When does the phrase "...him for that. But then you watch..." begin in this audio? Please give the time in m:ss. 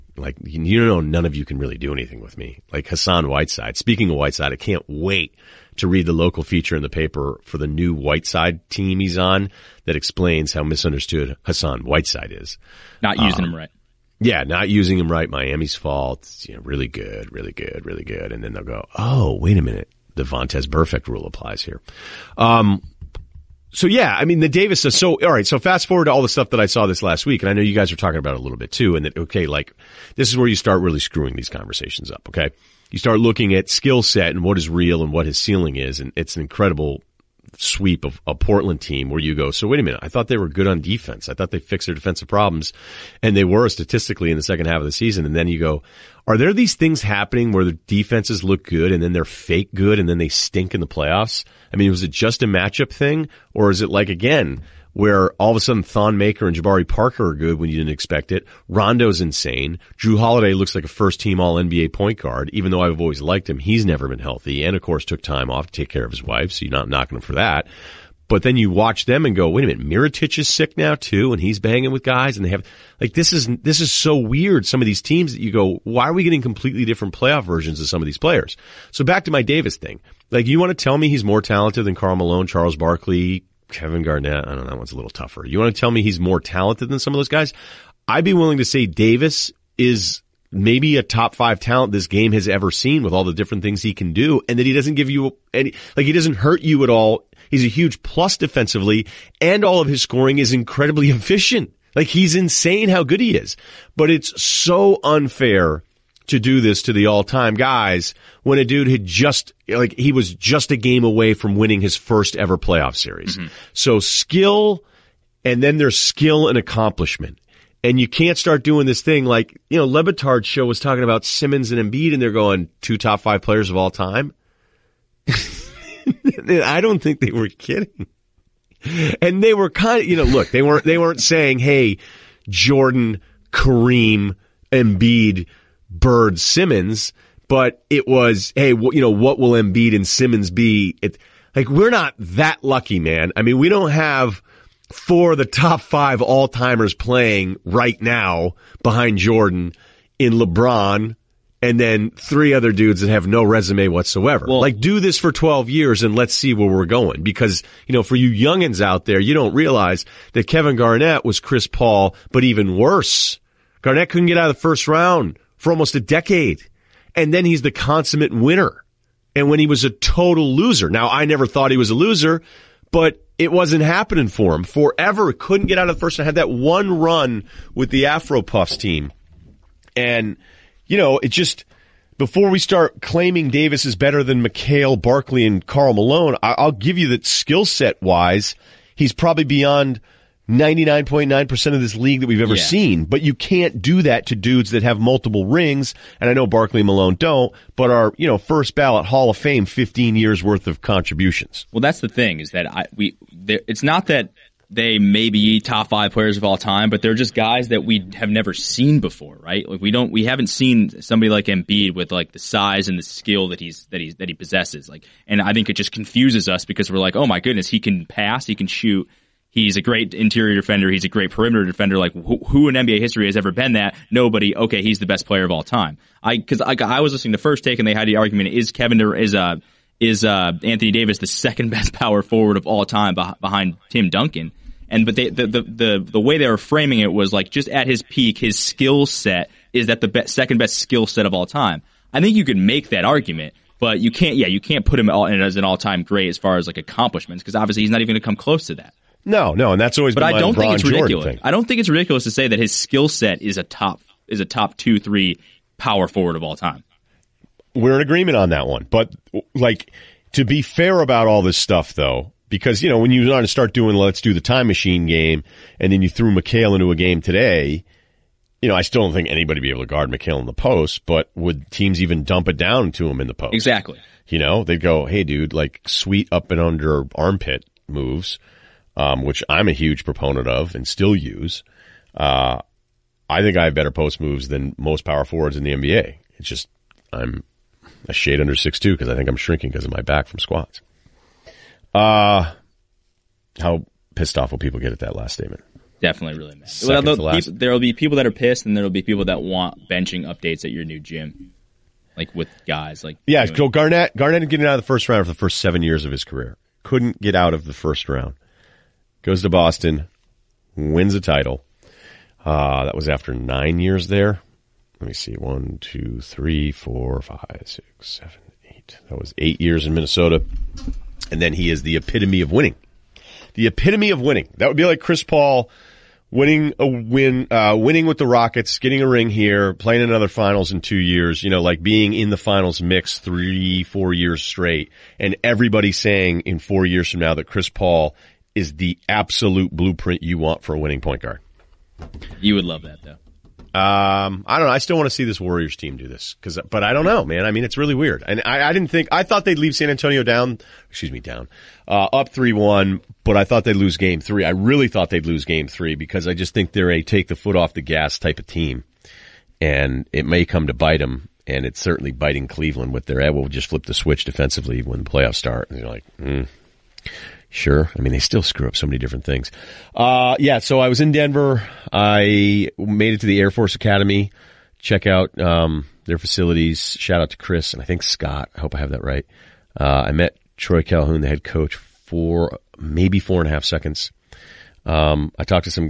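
1:07.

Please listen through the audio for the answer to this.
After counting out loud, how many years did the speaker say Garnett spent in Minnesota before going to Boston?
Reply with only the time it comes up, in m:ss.
5:19.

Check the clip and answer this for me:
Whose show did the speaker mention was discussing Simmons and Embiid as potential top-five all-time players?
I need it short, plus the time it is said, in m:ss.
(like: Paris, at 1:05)
Le Batard, at 1:59.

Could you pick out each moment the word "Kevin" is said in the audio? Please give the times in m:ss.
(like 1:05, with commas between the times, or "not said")
1:23, 2:40, 3:48.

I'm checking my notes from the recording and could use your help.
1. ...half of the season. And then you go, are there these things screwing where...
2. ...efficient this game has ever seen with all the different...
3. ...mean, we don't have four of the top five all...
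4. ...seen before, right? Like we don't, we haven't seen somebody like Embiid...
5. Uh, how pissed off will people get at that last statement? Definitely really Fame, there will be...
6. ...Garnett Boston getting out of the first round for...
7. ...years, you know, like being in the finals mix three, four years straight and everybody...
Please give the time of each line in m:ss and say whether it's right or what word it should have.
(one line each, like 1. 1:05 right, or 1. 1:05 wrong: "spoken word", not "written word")
1. 0:44 wrong: "happening", not "screwing"
2. 1:31 wrong: "talent", not "efficient"
3. 2:23 right
4. 3:28 right
5. 4:51 wrong: "Well", not "Fame"
6. 5:03 wrong: "Garnett", not "Boston"
7. 5:30 right.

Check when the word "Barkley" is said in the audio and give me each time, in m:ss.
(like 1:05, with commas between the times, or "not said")
1:22, 3:05, 3:16.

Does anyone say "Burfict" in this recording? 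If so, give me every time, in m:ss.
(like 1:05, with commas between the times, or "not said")
0:20.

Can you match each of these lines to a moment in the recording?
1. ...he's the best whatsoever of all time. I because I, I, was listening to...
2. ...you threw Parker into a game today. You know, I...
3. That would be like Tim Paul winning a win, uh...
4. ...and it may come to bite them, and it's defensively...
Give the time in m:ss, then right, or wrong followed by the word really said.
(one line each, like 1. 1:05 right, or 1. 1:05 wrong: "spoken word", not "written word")
1. 3:44 wrong: "player", not "whatsoever"
2. 4:26 wrong: "McHale", not "Parker"
3. 5:24 wrong: "Chris", not "Tim"
4. 5:59 wrong: "certainly", not "defensively".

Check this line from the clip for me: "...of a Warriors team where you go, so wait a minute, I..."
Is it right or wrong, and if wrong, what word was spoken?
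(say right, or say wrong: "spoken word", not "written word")
wrong: "Portland", not "Warriors".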